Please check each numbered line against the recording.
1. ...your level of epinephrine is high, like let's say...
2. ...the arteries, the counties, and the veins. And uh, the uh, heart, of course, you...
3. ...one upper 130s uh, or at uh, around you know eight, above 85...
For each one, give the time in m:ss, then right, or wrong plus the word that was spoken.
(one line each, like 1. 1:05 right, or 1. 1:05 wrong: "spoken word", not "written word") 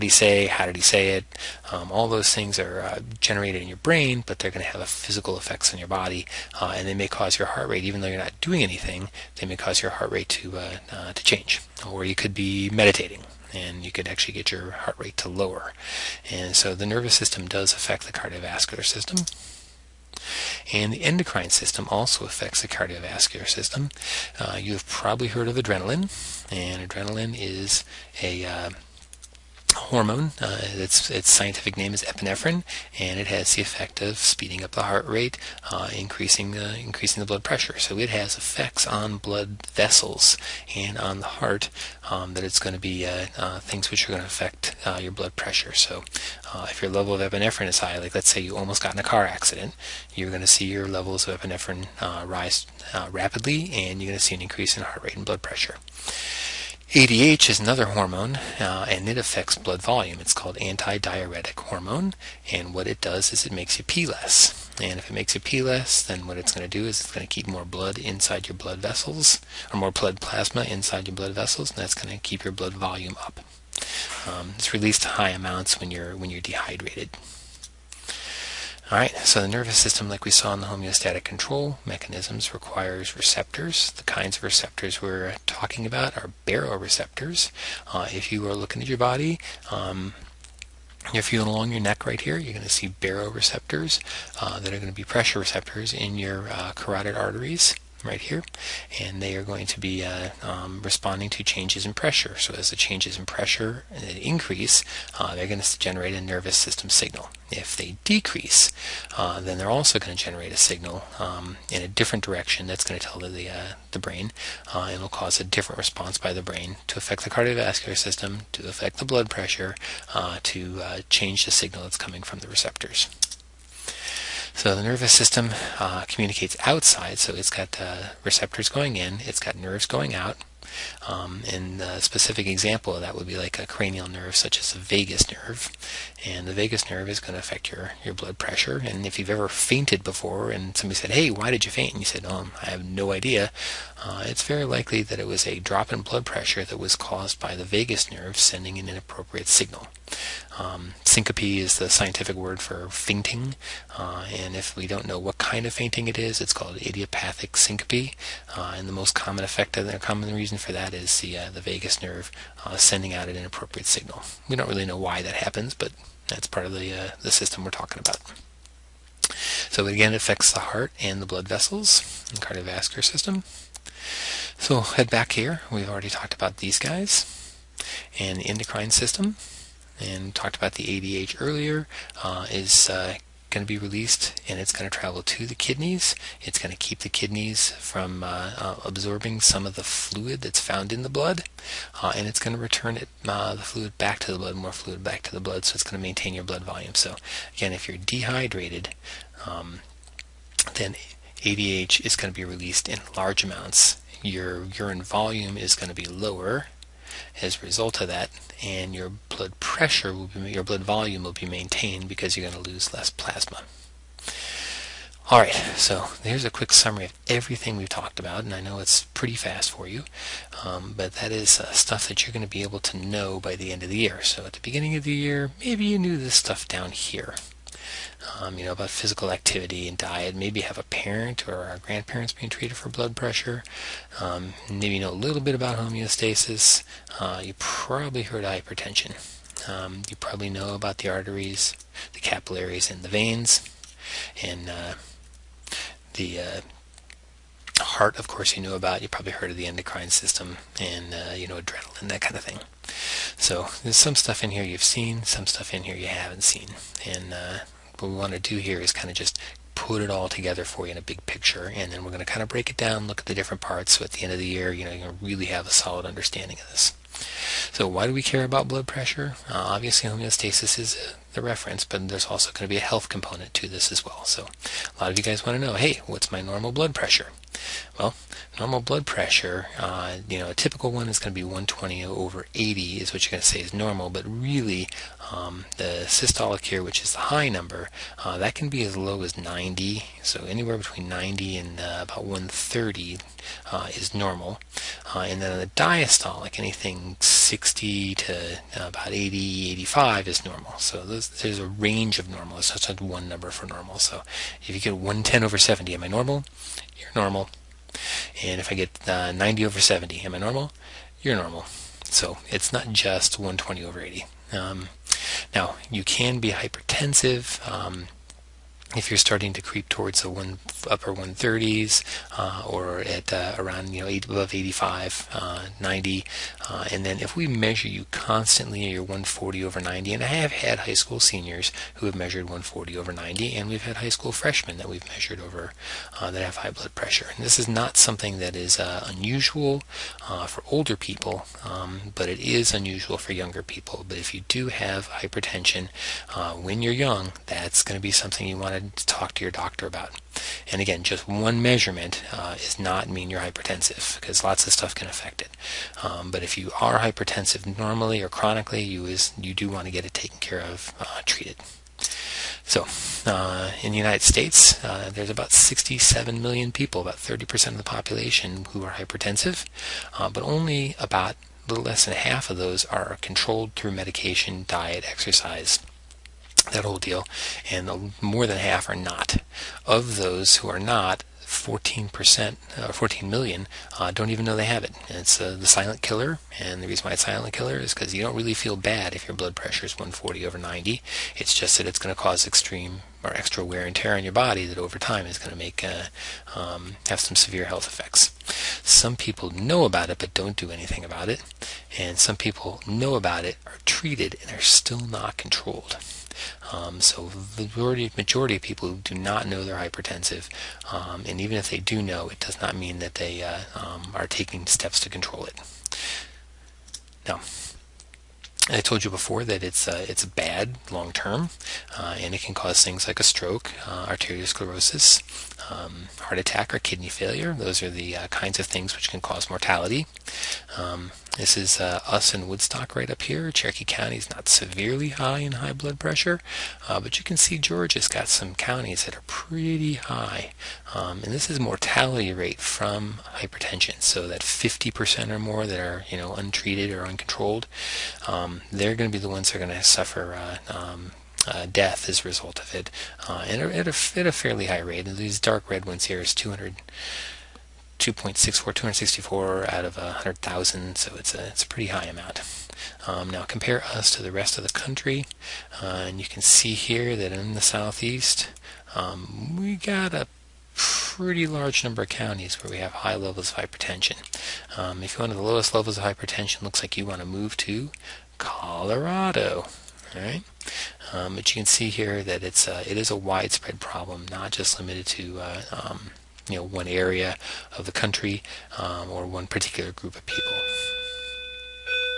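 1. 0:46 right
2. 4:00 wrong: "capillaries", not "counties"
3. 5:20 right.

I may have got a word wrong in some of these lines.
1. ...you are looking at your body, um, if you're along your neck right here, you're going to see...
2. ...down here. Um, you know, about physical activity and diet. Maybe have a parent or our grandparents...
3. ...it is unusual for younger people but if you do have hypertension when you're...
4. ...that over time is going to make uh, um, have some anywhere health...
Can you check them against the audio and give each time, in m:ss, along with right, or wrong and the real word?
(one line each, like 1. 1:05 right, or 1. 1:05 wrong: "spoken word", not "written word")
1. 1:28 right
2. 3:46 right
3. 5:42 right
4. 6:34 wrong: "severe", not "anywhere".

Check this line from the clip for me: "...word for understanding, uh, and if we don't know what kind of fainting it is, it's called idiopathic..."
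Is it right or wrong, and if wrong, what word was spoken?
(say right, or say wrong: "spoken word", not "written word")
wrong: "fainting", not "understanding".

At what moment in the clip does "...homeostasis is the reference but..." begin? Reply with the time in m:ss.
4:30.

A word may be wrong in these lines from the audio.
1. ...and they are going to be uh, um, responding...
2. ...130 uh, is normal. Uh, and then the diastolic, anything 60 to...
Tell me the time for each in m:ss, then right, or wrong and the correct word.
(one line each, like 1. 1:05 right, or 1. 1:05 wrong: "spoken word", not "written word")
1. 1:39 right
2. 4:52 right.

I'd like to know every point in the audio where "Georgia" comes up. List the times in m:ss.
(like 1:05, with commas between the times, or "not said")
7:17.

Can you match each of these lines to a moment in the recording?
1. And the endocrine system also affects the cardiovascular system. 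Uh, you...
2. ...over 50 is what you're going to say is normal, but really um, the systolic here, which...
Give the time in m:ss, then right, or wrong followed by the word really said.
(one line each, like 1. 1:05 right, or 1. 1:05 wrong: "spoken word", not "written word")
1. 0:20 right
2. 4:42 wrong: "80", not "50".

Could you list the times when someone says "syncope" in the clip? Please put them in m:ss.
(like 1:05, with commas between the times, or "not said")
2:31, 2:37.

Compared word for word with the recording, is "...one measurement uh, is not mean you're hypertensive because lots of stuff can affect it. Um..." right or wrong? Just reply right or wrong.
right.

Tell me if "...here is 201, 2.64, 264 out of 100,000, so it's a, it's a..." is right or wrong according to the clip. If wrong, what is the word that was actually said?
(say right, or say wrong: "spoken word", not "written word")
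wrong: "200", not "201".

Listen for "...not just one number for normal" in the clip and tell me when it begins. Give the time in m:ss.
5:02.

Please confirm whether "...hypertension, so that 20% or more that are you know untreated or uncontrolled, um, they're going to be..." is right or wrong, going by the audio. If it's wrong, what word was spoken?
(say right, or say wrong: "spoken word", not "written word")
wrong: "50", not "20".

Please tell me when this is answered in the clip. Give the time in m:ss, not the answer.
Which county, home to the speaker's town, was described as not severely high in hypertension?
7:13.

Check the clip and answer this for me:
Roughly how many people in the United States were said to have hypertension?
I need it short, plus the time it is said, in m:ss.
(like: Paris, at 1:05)
67 million, at 6:05.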